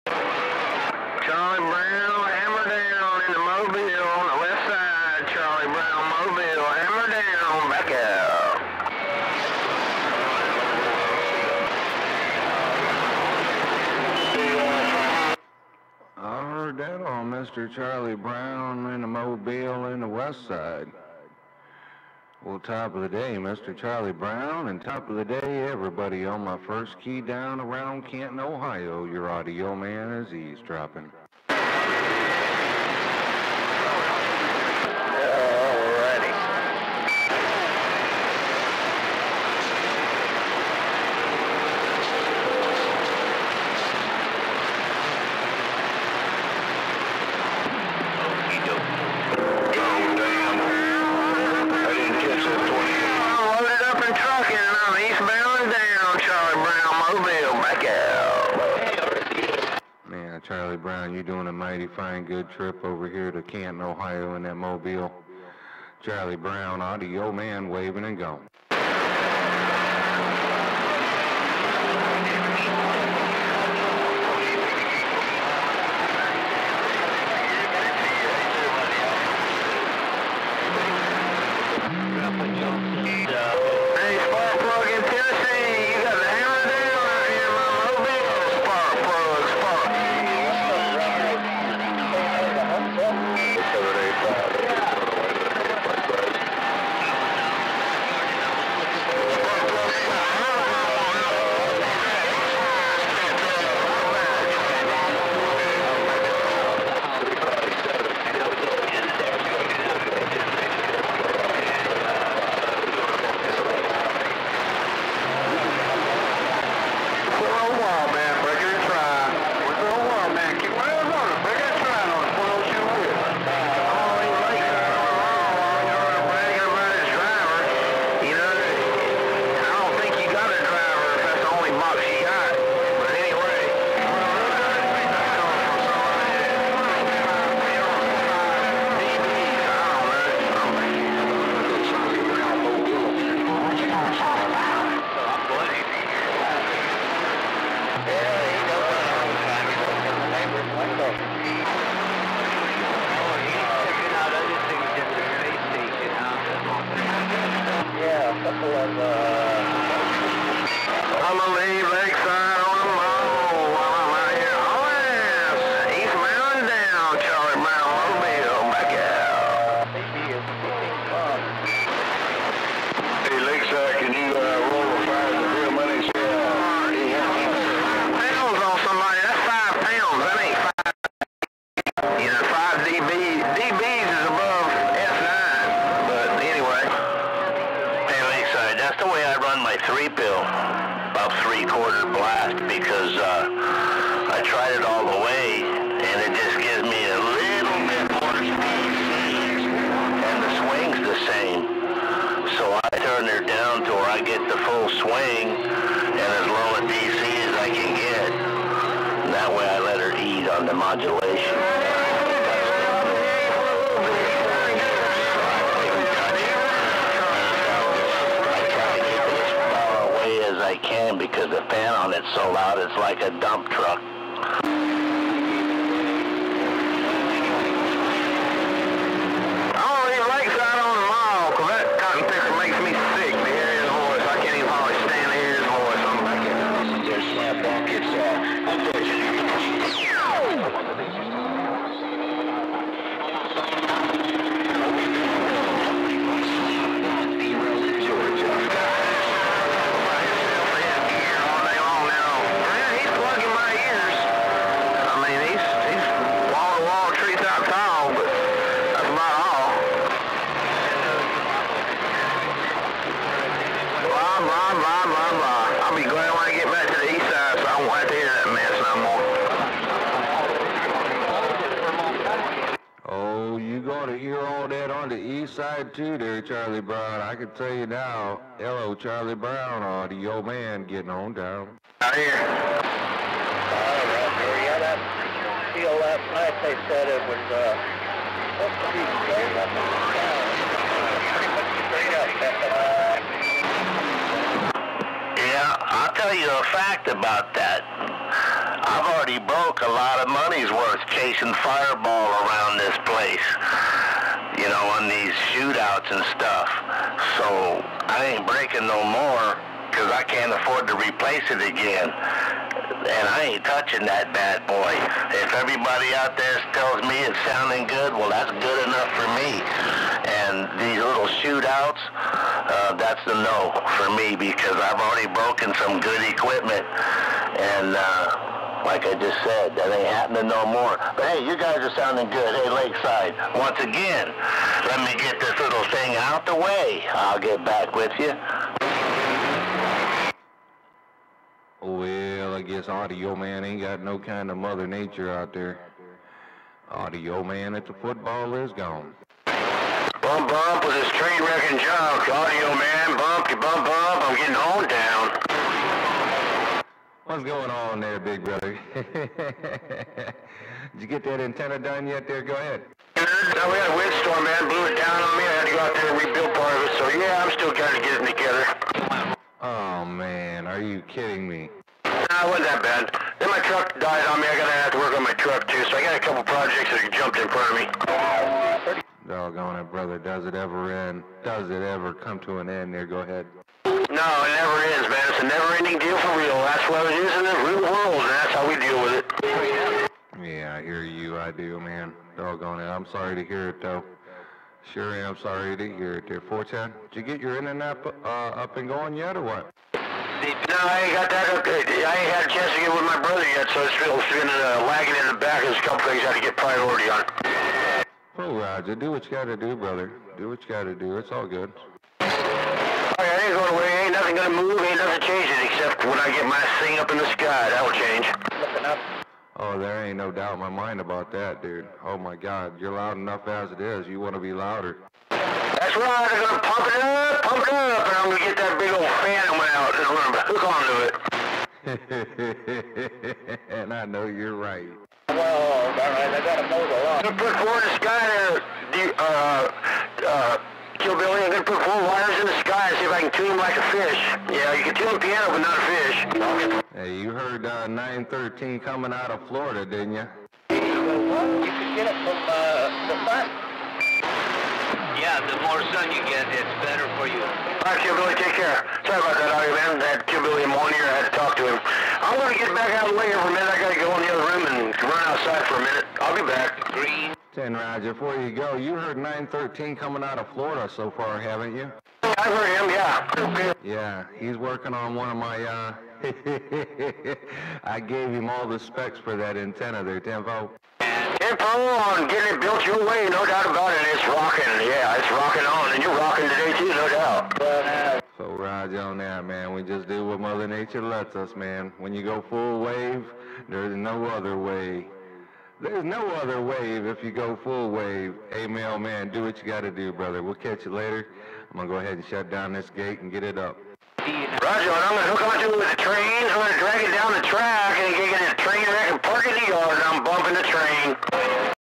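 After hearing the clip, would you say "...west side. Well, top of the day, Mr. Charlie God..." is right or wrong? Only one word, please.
wrong.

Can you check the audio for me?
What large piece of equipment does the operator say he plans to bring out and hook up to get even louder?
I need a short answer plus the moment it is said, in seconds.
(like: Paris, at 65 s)
Phantom, at 430 s.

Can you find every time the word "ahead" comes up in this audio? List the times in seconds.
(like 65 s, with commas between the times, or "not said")
362 s, 383 s, 501 s.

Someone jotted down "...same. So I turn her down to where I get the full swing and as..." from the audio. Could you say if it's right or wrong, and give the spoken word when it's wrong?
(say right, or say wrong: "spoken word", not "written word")
right.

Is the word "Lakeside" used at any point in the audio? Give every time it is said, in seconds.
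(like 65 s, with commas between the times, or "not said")
332 s.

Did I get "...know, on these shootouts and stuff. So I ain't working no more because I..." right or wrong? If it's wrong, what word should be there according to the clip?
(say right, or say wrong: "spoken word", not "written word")
wrong: "breaking", not "working".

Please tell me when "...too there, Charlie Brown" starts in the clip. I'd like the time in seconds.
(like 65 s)
275 s.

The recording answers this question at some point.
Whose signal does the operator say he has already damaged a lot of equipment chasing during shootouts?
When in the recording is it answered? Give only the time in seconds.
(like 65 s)
301 s.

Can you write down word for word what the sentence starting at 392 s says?
I'm sorry to hear it, though.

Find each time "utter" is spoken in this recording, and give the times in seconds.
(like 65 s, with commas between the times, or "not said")
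192 s.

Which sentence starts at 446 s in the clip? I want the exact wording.
Hey, you heard uh, 913 coming out of Florida, didn't you?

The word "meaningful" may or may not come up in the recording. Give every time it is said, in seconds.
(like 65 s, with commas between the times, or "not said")
not said.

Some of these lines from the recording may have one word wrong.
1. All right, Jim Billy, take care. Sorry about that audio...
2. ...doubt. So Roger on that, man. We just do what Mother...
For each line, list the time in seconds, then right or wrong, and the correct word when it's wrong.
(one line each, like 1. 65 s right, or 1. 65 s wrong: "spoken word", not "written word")
1. 457 s right
2. 487 s right.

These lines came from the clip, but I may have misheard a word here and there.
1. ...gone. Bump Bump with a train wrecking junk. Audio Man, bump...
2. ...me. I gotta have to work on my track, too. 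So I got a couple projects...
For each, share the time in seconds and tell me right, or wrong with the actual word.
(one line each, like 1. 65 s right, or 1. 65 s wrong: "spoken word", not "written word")
1. 348 s right
2. 374 s wrong: "truck", not "track".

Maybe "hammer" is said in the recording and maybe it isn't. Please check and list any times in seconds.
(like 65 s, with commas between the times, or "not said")
2 s, 6 s.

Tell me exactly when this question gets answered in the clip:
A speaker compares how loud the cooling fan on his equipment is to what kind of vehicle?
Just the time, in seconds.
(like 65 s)
223 s.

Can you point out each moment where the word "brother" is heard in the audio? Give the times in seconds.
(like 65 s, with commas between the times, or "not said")
358 s, 379 s, 403 s, 409 s, 500 s.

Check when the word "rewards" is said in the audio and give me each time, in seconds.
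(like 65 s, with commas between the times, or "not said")
not said.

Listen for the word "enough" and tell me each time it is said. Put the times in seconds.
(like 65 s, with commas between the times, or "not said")
318 s, 423 s.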